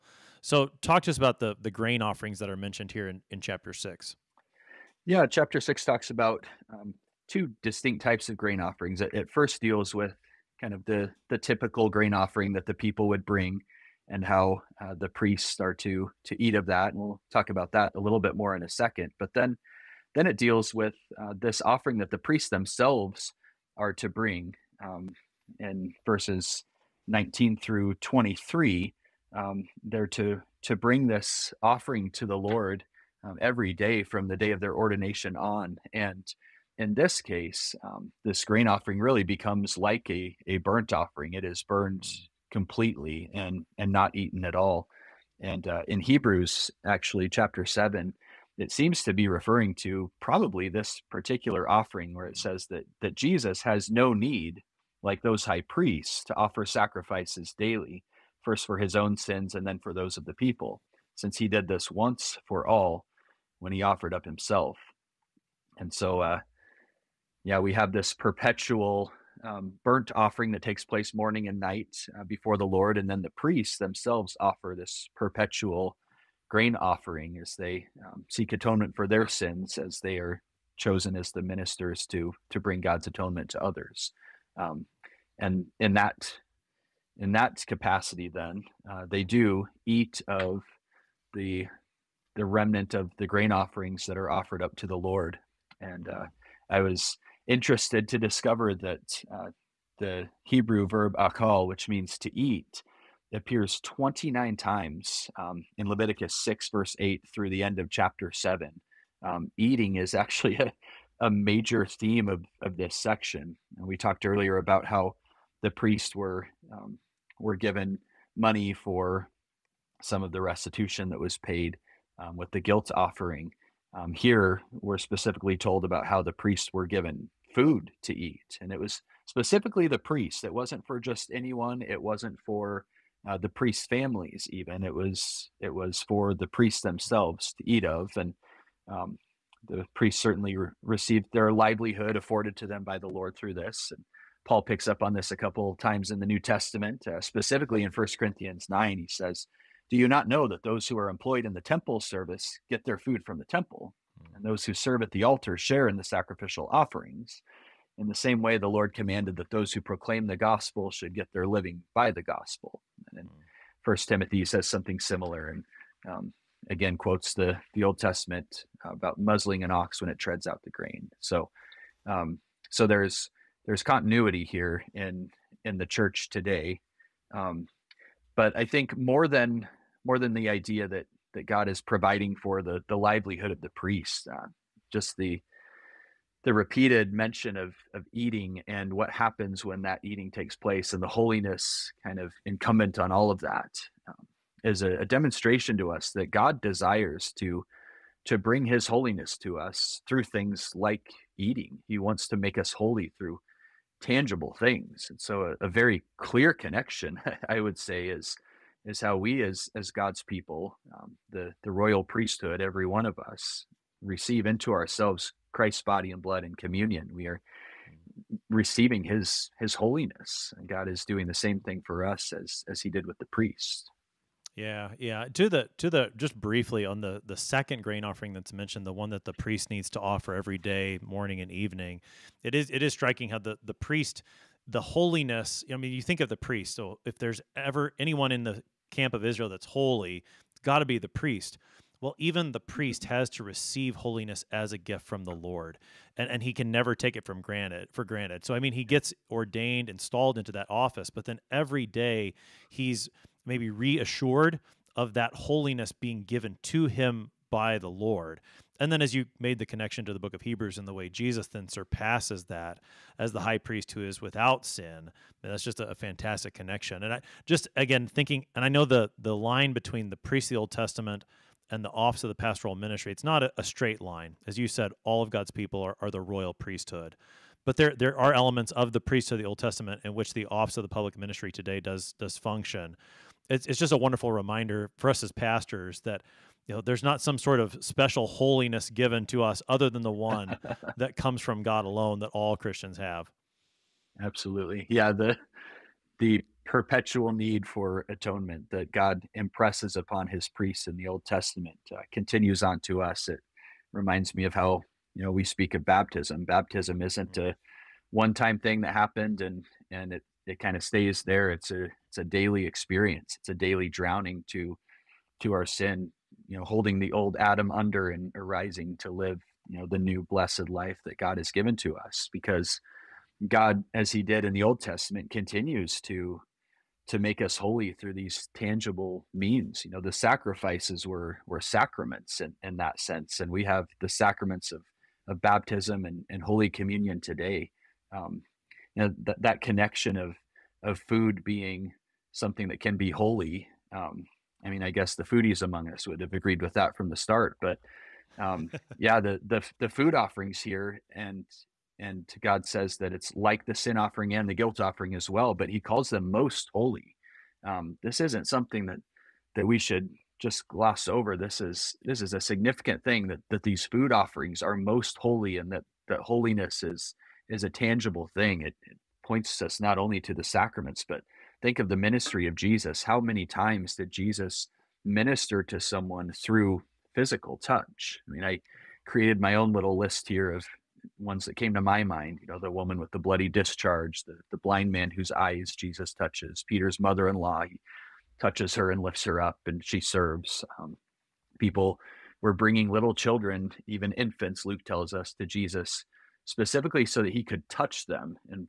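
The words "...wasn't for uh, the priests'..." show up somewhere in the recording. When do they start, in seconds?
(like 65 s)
132 s.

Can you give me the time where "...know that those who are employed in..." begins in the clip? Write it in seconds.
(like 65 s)
150 s.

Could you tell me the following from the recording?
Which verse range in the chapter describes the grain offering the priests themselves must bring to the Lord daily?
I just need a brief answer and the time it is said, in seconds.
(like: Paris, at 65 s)
19 through 23, at 27 s.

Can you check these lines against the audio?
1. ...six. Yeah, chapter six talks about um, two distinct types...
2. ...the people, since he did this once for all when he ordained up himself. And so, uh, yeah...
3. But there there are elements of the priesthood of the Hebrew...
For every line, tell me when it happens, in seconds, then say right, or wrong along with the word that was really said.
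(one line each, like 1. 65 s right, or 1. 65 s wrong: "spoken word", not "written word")
1. 3 s right
2. 60 s wrong: "offered", not "ordained"
3. 277 s wrong: "Old", not "Hebrew".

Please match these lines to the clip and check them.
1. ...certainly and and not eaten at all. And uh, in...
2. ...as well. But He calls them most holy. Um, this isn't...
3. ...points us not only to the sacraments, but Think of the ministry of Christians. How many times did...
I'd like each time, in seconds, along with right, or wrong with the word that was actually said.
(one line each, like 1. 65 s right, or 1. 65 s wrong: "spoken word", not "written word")
1. 42 s wrong: "completely", not "certainly"
2. 355 s right
3. 369 s wrong: "Jesus", not "Christians".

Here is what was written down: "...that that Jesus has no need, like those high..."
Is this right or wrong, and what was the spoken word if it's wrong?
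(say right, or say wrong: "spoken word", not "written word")
right.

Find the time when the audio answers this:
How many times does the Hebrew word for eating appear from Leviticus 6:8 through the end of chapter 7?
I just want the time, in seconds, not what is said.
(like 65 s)
103 s.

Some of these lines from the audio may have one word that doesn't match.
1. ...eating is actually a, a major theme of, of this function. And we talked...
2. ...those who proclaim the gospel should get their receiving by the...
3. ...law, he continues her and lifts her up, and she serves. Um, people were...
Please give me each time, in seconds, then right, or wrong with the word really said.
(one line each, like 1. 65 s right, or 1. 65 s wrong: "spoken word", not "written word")
1. 109 s wrong: "section", not "function"
2. 159 s wrong: "living", not "receiving"
3. 387 s wrong: "touches", not "continues".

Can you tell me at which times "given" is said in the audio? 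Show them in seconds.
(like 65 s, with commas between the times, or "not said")
117 s, 126 s, 256 s, 288 s, 321 s.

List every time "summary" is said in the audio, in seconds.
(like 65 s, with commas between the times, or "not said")
not said.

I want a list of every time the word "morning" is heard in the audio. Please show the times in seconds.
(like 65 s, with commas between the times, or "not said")
71 s, 231 s.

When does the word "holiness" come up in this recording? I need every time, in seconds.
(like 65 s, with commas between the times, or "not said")
191 s, 198 s, 219 s, 234 s, 243 s, 255 s, 288 s, 366 s.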